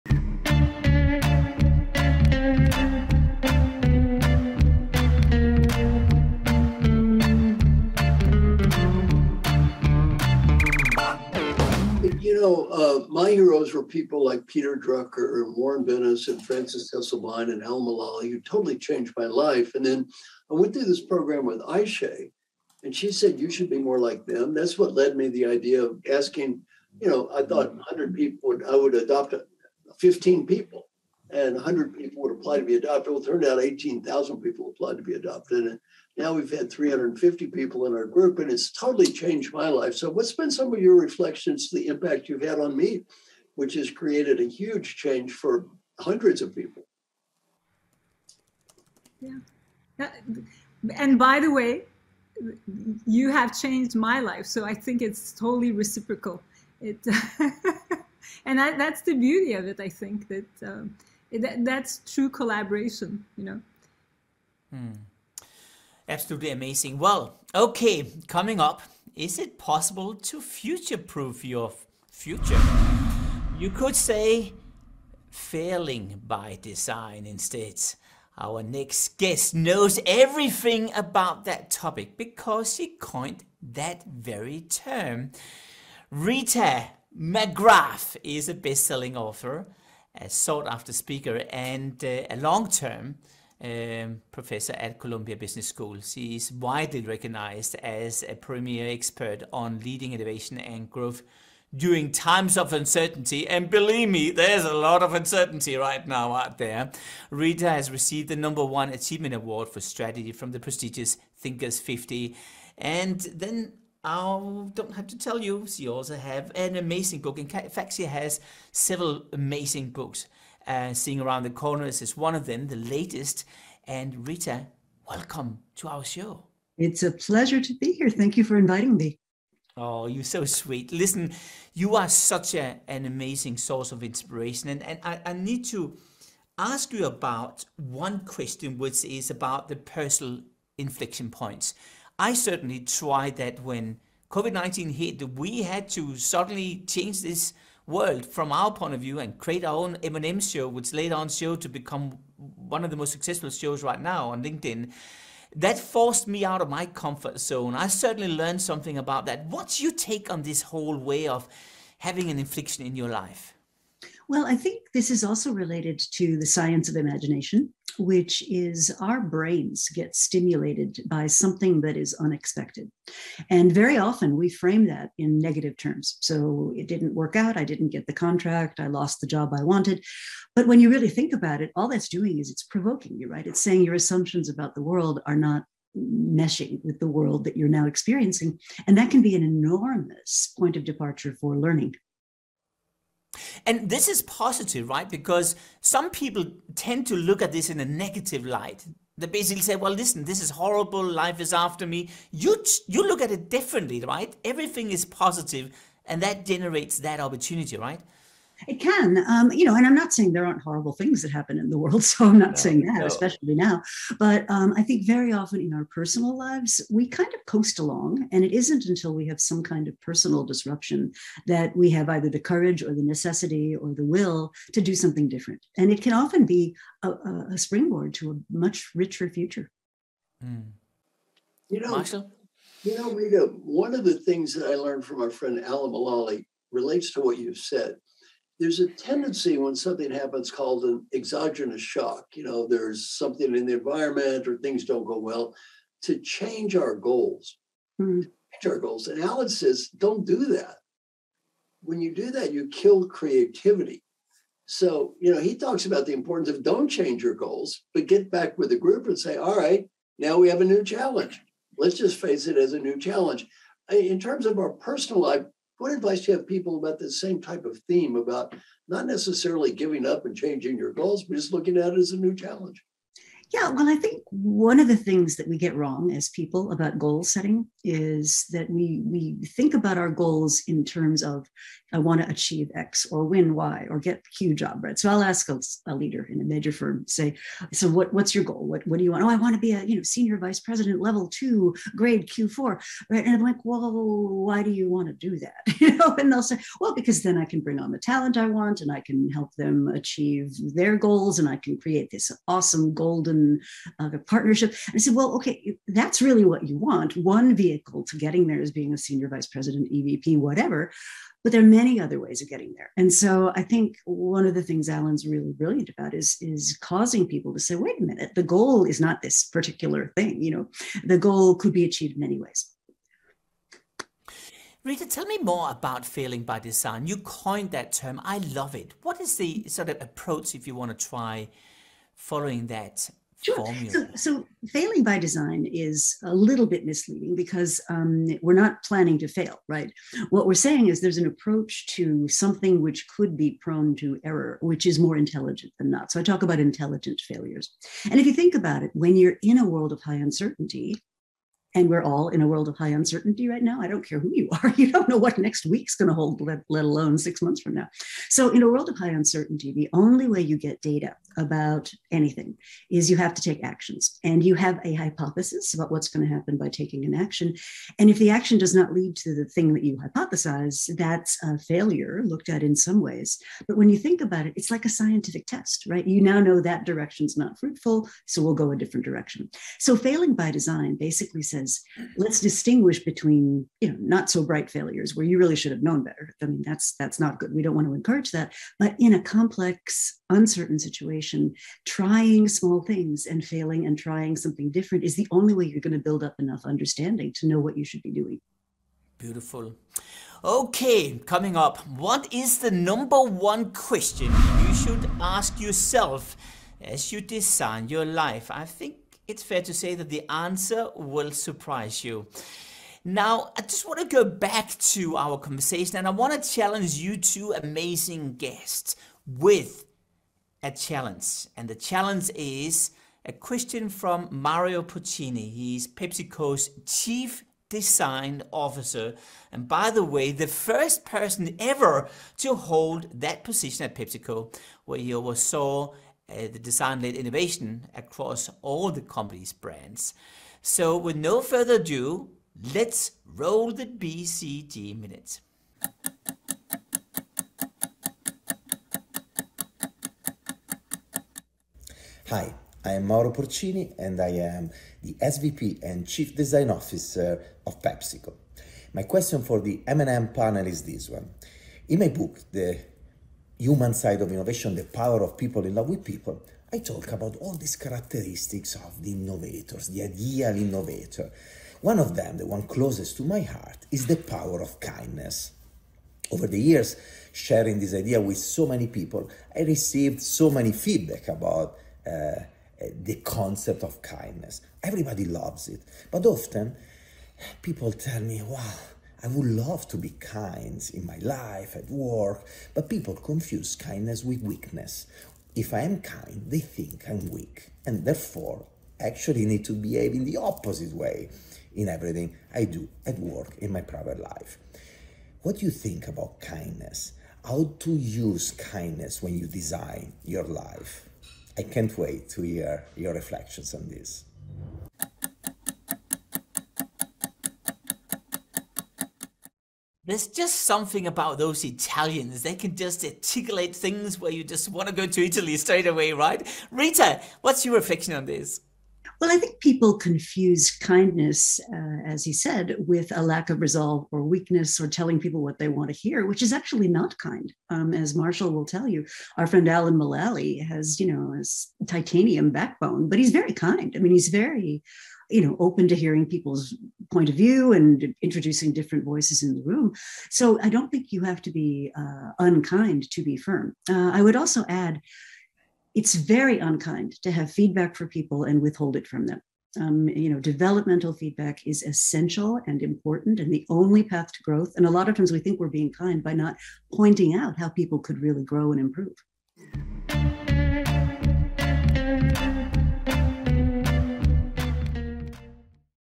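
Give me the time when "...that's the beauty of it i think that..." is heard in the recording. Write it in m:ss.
0:58.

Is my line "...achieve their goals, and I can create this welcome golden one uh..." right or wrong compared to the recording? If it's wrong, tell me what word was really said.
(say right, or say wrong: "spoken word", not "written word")
wrong: "awesome", not "welcome".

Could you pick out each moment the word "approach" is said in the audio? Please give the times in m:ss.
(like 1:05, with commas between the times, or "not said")
5:30, 5:41.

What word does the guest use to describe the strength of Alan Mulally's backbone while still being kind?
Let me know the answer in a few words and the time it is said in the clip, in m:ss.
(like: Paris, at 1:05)
titanium, at 9:01.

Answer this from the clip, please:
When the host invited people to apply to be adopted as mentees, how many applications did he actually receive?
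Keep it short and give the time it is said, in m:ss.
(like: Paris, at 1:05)
18,000, at 0:33.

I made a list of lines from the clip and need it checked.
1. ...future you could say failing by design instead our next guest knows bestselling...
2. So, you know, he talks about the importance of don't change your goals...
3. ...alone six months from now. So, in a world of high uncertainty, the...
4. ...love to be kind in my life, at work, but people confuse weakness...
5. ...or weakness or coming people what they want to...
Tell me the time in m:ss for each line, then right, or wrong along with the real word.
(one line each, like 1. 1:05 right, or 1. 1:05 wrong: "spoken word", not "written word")
1. 1:12 wrong: "everything", not "bestselling"
2. 4:14 right
3. 5:56 right
4. 8:09 wrong: "kindness", not "weakness"
5. 8:54 wrong: "telling", not "coming".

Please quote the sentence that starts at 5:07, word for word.
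One vehicle to getting there is being a senior vice president, EVP, whatever.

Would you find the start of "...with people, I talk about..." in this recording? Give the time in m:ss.
7:45.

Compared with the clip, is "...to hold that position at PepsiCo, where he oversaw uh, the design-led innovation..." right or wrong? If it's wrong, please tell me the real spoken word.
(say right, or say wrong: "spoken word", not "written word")
right.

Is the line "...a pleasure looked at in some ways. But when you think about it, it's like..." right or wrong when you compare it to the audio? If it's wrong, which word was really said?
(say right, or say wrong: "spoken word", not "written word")
wrong: "failure", not "pleasure".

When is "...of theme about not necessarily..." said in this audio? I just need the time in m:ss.
4:27.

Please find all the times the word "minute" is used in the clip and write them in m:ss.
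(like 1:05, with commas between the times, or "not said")
5:18, 7:24.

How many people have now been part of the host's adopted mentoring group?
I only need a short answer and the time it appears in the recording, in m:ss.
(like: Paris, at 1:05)
350, at 0:36.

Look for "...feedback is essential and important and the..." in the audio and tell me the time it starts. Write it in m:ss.
9:21.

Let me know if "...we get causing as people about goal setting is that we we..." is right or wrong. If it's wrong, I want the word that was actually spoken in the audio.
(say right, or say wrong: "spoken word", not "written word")
wrong: "wrong", not "causing".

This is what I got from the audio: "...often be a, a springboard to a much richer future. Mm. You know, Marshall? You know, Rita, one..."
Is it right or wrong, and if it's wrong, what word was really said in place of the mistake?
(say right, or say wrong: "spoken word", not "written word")
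right.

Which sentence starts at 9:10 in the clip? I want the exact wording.
So I don't think you have to be uh, unkind to be firm.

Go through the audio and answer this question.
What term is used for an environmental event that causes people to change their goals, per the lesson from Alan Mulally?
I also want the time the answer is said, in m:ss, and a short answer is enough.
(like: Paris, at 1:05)
exogenous shock, at 4:01.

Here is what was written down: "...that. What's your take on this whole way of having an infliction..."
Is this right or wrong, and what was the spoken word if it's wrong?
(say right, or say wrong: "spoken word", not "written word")
right.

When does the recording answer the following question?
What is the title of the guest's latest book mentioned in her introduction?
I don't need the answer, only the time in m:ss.
2:00.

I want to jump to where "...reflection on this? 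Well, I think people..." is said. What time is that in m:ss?
8:47.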